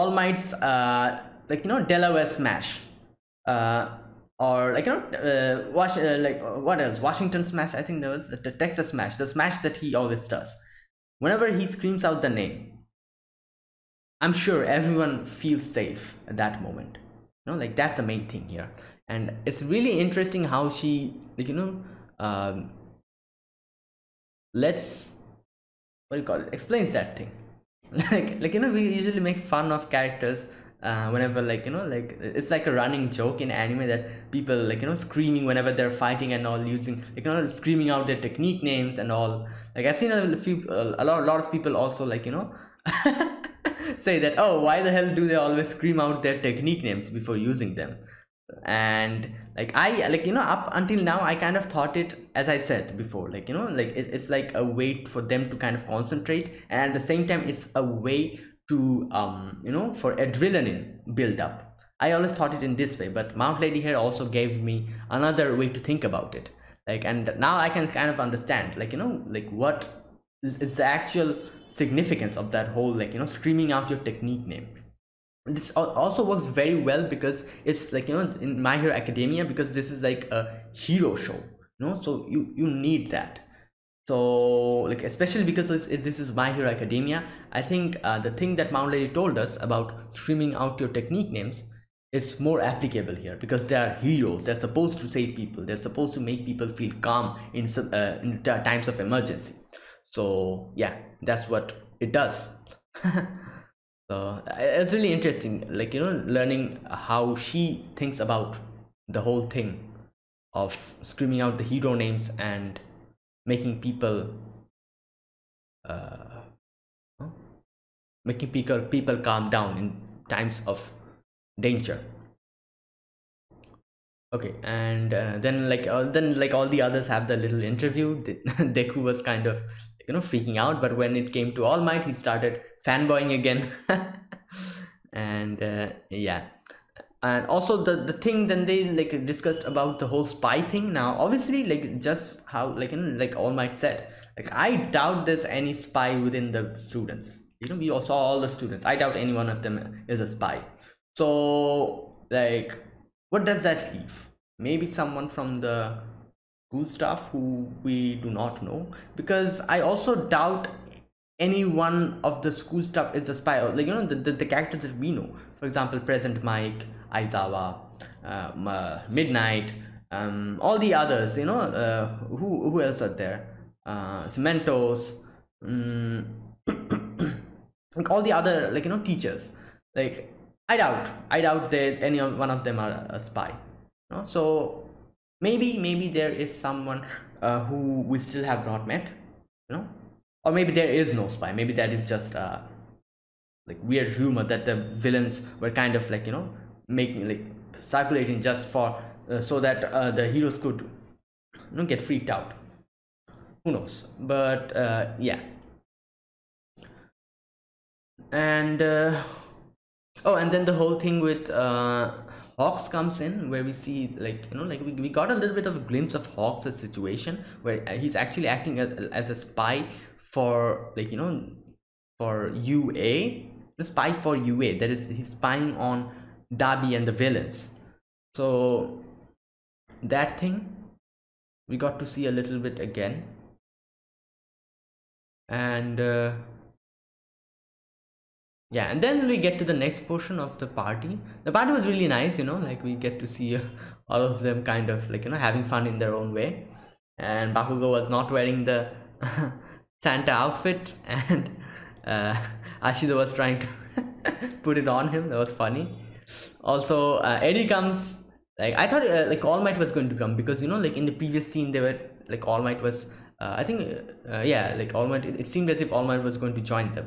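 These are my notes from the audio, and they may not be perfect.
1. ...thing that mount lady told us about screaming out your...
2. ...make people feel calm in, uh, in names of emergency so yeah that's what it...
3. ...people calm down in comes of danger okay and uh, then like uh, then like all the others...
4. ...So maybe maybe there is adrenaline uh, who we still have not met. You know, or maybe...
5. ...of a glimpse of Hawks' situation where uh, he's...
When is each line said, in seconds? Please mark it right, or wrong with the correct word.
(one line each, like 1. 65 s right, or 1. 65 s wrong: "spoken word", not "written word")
1. 88 s right
2. 96 s wrong: "times", not "names"
3. 118 s wrong: "times", not "comes"
4. 184 s wrong: "someone", not "adrenaline"
5. 215 s right.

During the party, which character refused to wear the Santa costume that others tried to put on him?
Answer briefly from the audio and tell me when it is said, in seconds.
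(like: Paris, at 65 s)
Bakugo, at 247 s.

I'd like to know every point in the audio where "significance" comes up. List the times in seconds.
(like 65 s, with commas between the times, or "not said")
71 s.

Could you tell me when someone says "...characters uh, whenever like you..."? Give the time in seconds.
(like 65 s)
29 s.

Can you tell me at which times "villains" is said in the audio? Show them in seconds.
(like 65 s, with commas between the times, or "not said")
194 s, 227 s.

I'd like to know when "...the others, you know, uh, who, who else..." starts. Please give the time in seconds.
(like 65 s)
170 s.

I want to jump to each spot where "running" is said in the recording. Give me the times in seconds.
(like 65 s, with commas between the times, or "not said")
32 s.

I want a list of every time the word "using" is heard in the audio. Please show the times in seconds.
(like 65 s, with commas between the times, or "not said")
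36 s, 47 s.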